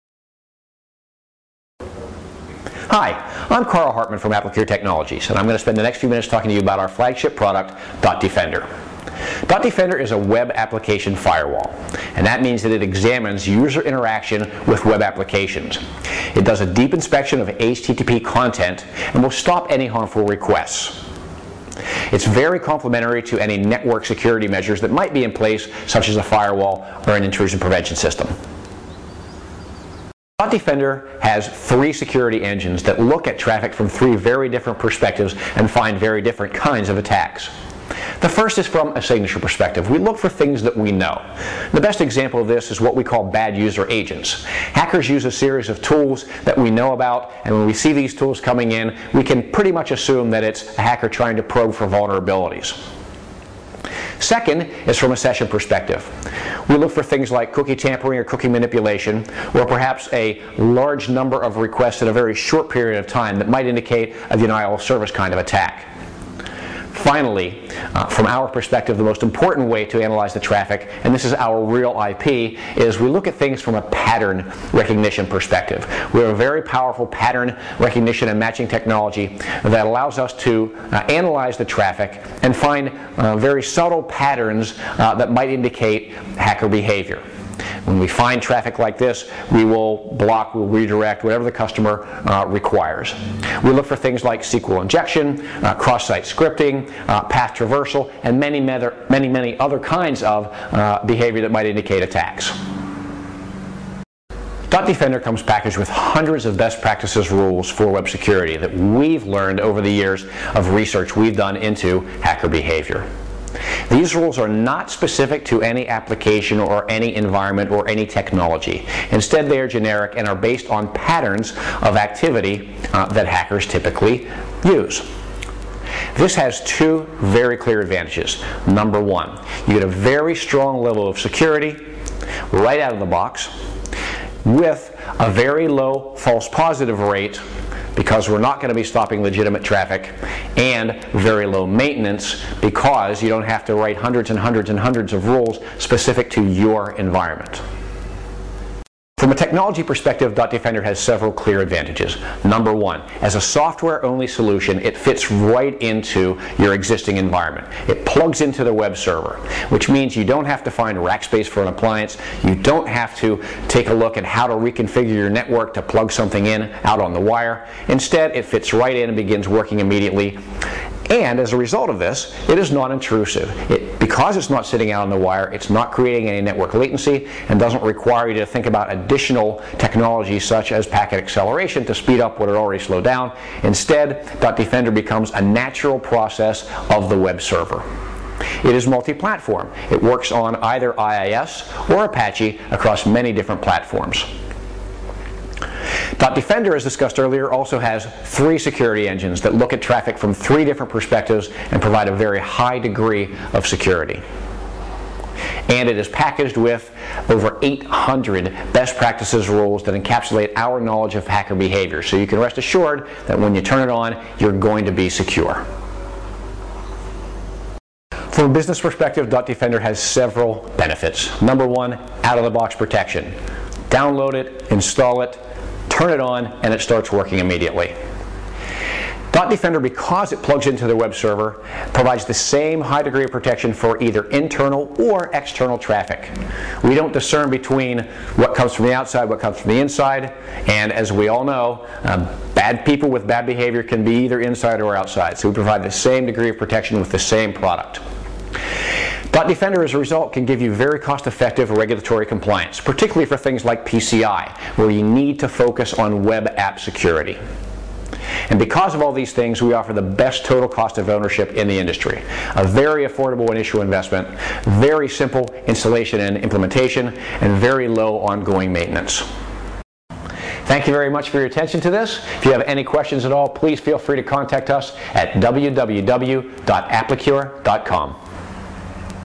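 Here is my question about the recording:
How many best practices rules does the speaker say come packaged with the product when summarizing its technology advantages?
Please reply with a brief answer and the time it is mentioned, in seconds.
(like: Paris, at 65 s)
800, at 207 s.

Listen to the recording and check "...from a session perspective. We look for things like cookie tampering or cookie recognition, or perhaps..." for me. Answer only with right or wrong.
wrong.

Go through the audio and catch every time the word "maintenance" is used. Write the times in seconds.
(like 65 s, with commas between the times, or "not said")
141 s, 268 s.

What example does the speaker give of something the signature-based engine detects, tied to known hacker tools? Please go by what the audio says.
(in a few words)
Bad user agents.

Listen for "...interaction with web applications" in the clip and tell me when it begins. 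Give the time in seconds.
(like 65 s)
13 s.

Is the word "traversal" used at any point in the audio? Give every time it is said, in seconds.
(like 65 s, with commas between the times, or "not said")
97 s.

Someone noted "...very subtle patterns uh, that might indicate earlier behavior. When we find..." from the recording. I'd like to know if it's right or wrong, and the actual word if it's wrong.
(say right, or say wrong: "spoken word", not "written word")
wrong: "hacker", not "earlier".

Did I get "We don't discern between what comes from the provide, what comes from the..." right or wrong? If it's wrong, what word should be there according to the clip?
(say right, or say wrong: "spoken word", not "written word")
wrong: "outside", not "provide".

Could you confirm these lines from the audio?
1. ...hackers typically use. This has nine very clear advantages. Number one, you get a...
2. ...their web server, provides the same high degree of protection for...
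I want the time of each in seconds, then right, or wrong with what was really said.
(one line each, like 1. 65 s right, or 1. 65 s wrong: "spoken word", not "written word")
1. 123 s wrong: "two", not "nine"
2. 230 s right.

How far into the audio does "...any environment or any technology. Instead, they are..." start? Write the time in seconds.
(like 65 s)
116 s.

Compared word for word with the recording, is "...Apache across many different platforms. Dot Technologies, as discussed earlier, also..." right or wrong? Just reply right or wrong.
wrong.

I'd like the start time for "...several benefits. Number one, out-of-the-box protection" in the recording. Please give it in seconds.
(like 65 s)
219 s.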